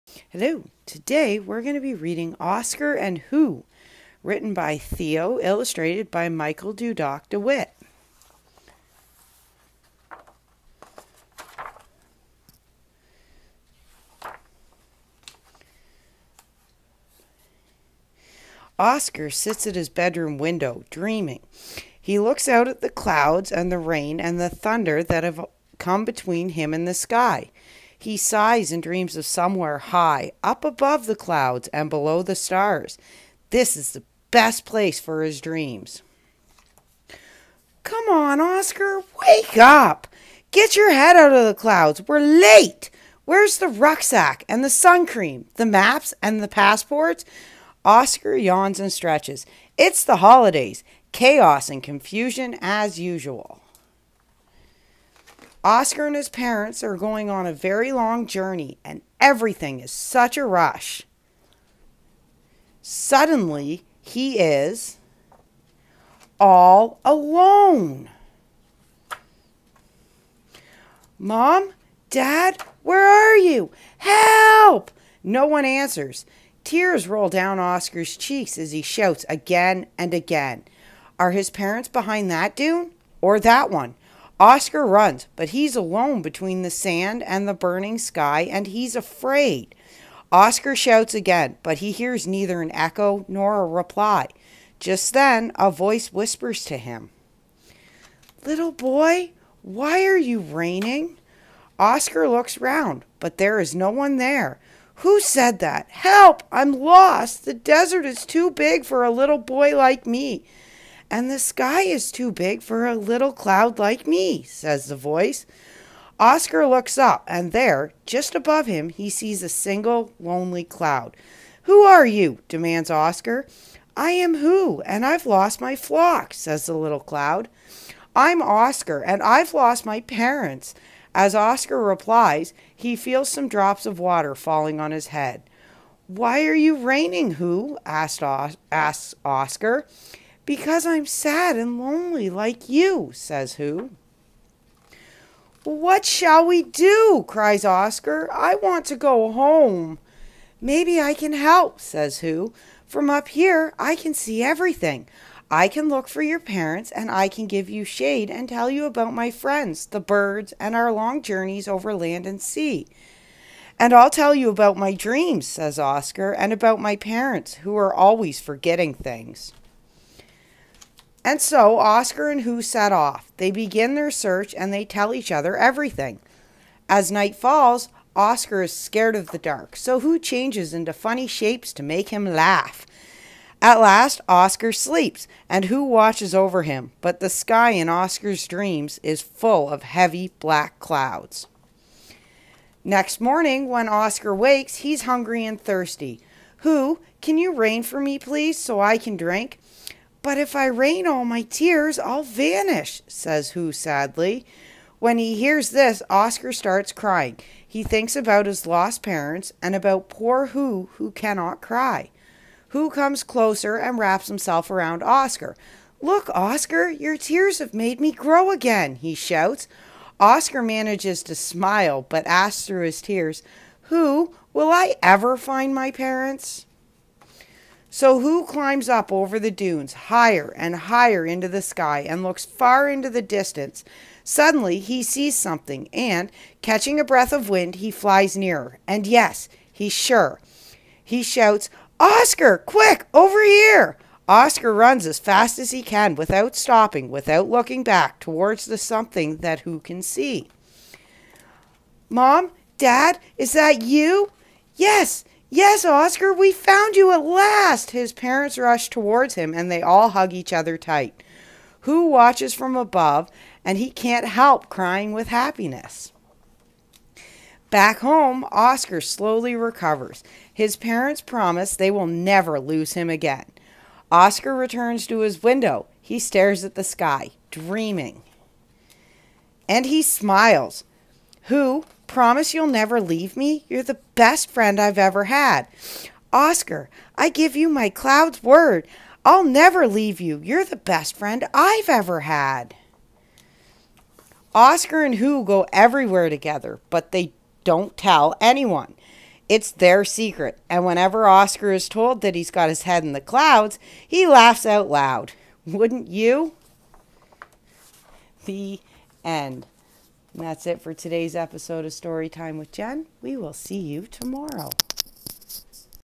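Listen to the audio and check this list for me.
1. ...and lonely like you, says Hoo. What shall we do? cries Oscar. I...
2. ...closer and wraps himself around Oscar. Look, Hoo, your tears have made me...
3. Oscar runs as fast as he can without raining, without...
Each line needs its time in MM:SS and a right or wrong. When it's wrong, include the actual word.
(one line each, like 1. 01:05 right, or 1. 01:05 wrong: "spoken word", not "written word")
1. 02:21 right
2. 03:33 wrong: "Oscar", not "Hoo"
3. 04:04 wrong: "stopping", not "raining".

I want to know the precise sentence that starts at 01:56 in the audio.
Oscar looks up, and there, just above him, he sees a single lonely cloud.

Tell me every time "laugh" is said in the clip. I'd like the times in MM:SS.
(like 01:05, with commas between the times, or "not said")
03:02, 05:04.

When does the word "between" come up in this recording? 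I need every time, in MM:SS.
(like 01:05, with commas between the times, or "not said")
00:26, 01:26.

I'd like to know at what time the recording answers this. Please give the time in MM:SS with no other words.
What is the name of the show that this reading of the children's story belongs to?
05:11.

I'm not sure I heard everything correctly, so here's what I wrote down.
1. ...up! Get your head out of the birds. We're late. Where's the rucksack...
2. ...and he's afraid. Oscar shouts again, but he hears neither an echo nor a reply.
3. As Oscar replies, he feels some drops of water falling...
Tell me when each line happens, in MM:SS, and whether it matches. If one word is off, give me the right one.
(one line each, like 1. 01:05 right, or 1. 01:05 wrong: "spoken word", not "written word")
1. 00:39 wrong: "clouds", not "birds"
2. 01:28 right
3. 02:11 right.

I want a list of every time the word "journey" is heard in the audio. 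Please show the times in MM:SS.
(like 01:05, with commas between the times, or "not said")
00:58, 02:41.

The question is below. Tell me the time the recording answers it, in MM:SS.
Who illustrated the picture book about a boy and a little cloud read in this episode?
00:06.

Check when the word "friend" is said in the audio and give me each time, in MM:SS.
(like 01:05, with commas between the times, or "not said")
02:39, 04:44, 04:51.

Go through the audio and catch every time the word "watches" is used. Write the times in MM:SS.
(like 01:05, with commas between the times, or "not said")
03:05, 04:22.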